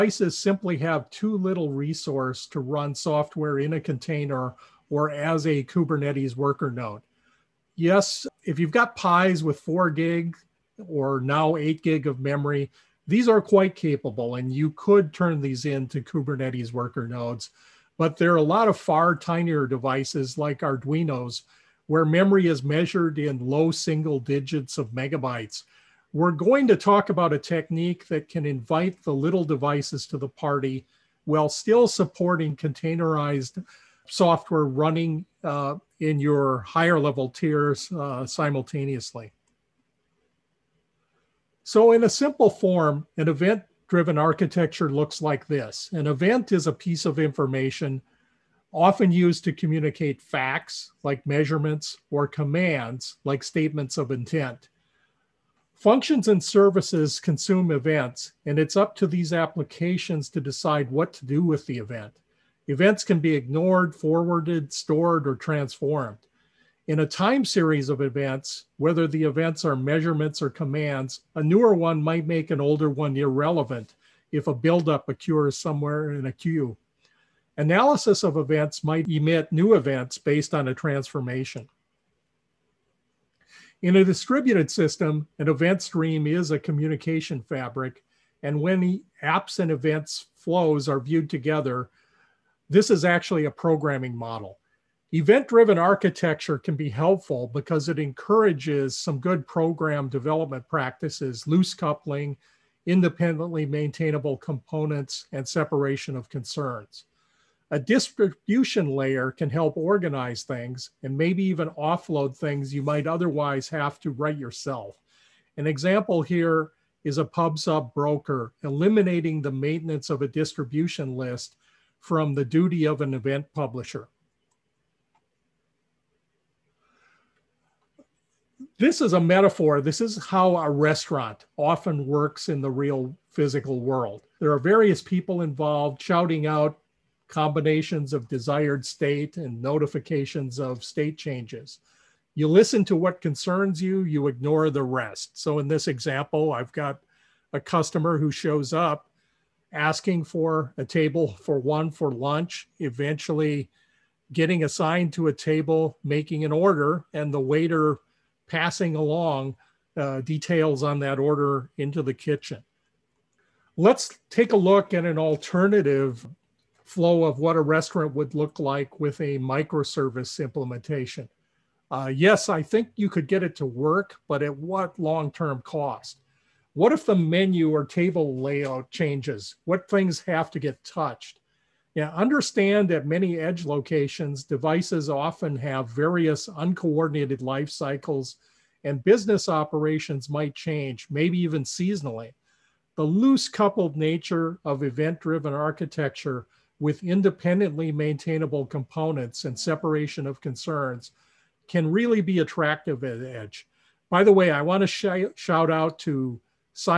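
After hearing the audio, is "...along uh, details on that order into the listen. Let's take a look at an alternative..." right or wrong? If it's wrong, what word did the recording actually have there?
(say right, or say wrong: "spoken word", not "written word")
wrong: "kitchen", not "listen".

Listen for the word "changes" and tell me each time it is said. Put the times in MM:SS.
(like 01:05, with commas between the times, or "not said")
02:21, 02:58, 03:10.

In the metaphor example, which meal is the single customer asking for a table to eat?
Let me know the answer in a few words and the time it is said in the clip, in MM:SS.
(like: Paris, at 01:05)
Lunch, at 02:32.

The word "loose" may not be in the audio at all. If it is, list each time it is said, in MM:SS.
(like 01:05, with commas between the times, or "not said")
01:41, 03:13.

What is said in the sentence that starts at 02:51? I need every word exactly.
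Uh, yes, I think you could get it to work, but at what long term cost?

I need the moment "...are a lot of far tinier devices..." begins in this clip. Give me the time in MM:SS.
00:18.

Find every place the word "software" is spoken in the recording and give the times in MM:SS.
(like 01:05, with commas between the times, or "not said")
00:02, 00:34.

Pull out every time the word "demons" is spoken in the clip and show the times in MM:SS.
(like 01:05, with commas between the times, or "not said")
not said.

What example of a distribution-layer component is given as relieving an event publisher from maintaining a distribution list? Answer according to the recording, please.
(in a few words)
PubSub broker.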